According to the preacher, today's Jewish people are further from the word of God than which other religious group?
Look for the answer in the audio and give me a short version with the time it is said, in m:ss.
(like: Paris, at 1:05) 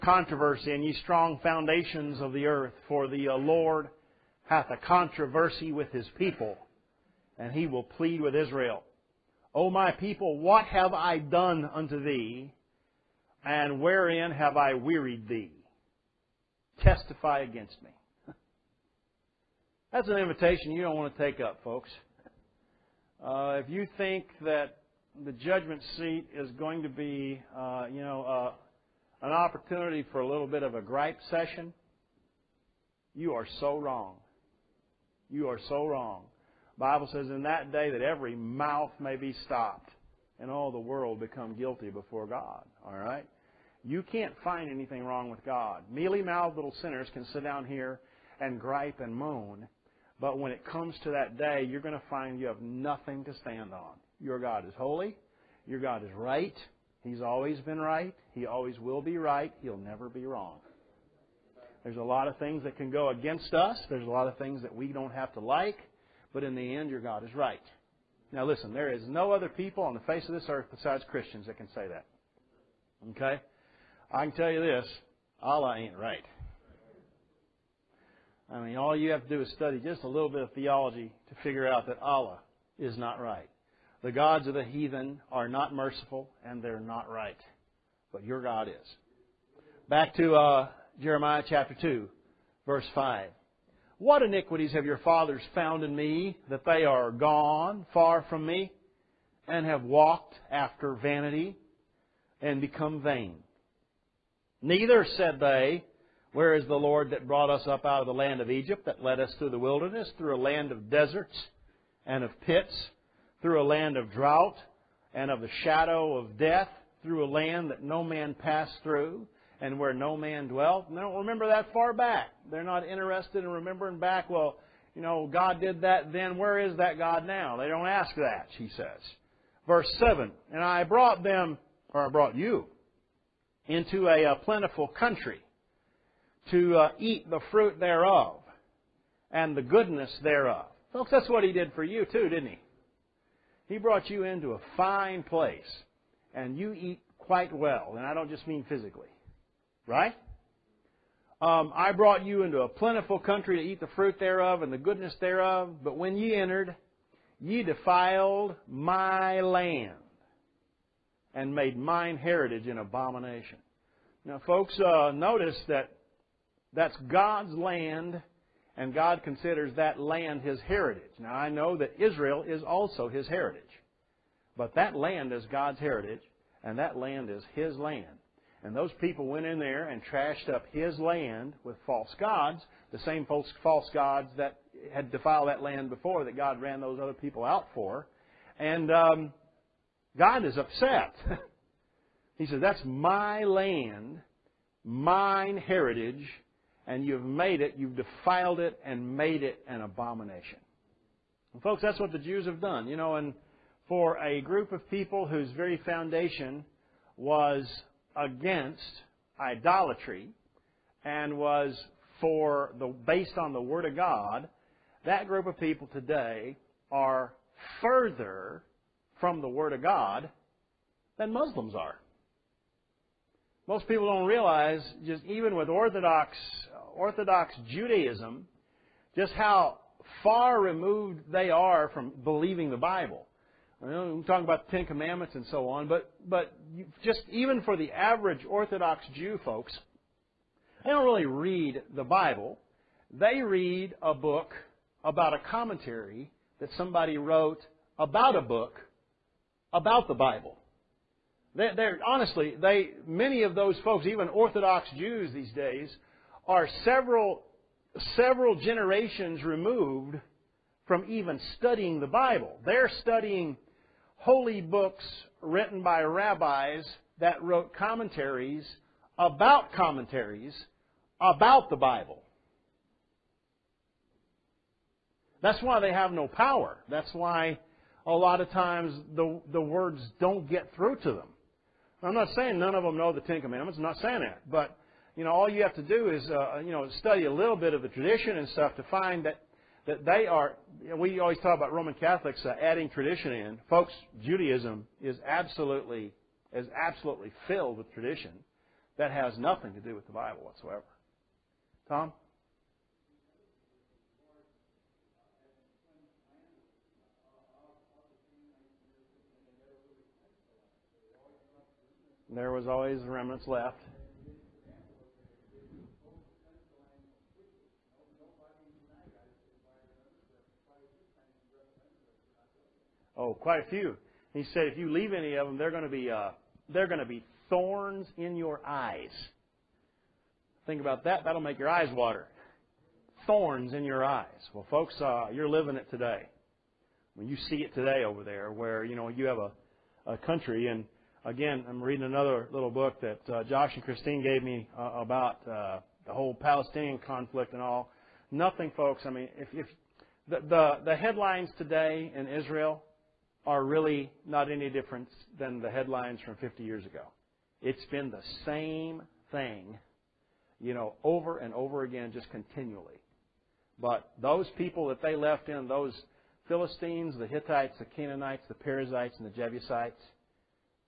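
Muslims, at 3:41.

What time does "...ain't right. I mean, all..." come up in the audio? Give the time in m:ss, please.
1:15.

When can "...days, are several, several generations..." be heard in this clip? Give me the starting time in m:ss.
4:15.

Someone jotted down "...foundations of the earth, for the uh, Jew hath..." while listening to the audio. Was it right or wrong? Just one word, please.
wrong.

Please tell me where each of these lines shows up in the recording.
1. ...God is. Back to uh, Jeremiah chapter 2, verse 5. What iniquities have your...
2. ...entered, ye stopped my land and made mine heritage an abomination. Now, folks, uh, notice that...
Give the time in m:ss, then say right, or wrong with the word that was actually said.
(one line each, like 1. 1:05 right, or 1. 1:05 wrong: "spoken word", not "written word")
1. 1:28 right
2. 2:36 wrong: "defiled", not "stopped".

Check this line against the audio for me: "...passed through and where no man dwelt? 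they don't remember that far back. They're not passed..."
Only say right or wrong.
wrong.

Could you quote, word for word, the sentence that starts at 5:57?
It's been the same thing, you know, over and over again, just continually.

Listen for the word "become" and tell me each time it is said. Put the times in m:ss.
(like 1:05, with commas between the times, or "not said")
0:41, 1:42.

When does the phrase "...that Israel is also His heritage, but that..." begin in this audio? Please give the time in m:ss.
2:51.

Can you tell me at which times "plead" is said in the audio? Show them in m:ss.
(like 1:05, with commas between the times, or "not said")
0:07.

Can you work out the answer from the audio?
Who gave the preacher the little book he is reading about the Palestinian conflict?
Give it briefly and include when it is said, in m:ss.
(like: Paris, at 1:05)
Josh and Christine, at 5:43.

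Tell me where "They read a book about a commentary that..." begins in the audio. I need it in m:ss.
4:03.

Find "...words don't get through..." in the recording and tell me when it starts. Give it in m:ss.
4:39.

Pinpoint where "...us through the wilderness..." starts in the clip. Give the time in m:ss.
1:49.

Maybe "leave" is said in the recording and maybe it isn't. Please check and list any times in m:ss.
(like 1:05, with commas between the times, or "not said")
5:24.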